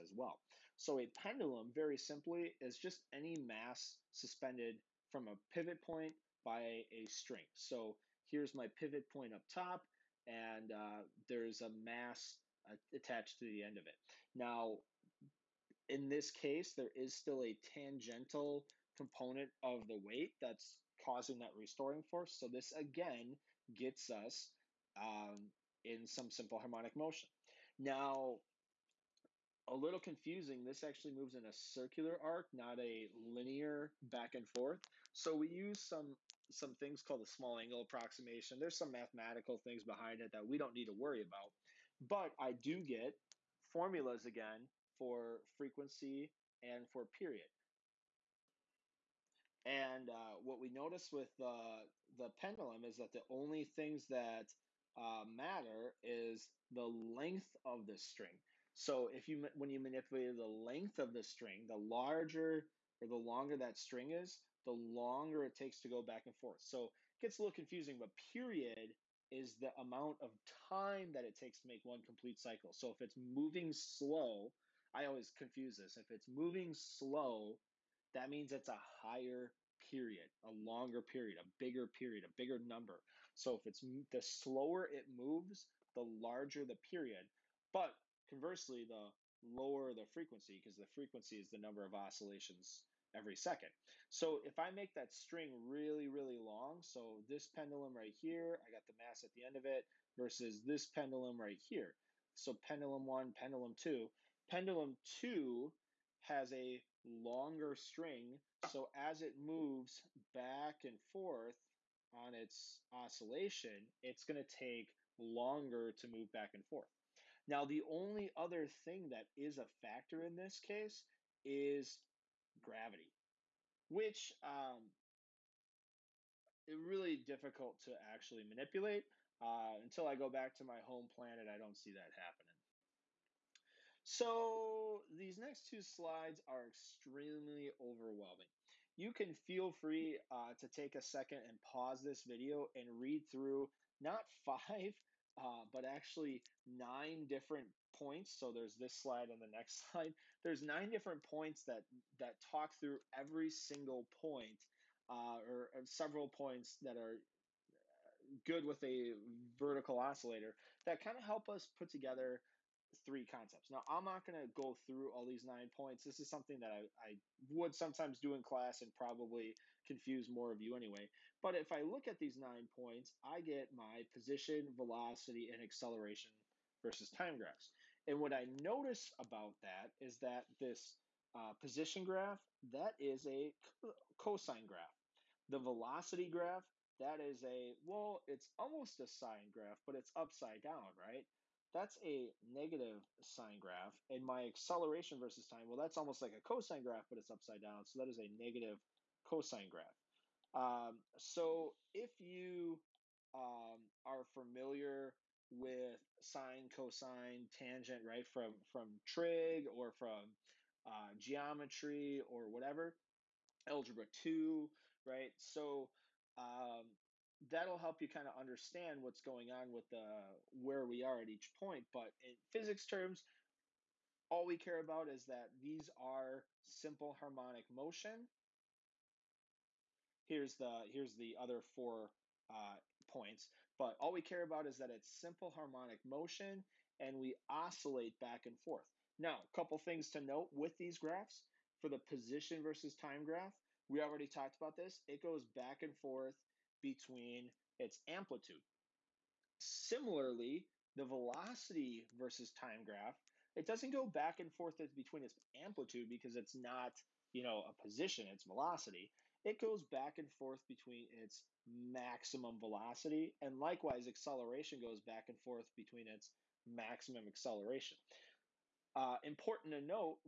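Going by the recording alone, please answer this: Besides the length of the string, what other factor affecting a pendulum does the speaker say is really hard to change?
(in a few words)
Gravity.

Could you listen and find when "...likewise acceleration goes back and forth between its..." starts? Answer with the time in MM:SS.
04:23.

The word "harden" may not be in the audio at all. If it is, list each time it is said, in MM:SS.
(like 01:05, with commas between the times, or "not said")
not said.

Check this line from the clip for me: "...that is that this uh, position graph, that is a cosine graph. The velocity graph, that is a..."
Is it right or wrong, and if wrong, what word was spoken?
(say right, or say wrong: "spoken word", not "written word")
right.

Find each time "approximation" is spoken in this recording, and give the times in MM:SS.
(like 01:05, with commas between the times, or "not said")
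00:37.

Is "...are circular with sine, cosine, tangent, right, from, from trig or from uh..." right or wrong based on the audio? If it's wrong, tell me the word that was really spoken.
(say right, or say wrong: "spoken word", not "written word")
wrong: "familiar", not "circular".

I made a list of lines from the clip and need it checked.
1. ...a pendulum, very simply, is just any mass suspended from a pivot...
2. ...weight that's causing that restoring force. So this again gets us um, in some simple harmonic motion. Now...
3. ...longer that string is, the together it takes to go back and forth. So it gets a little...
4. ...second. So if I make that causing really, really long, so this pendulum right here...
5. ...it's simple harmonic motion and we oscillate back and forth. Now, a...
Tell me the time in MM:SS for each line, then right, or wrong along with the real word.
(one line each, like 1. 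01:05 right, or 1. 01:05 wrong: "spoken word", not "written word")
1. 00:00 right
2. 00:19 right
3. 01:03 wrong: "longer", not "together"
4. 01:33 wrong: "string", not "causing"
5. 03:54 right.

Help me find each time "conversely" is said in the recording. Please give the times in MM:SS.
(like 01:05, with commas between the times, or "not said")
01:28.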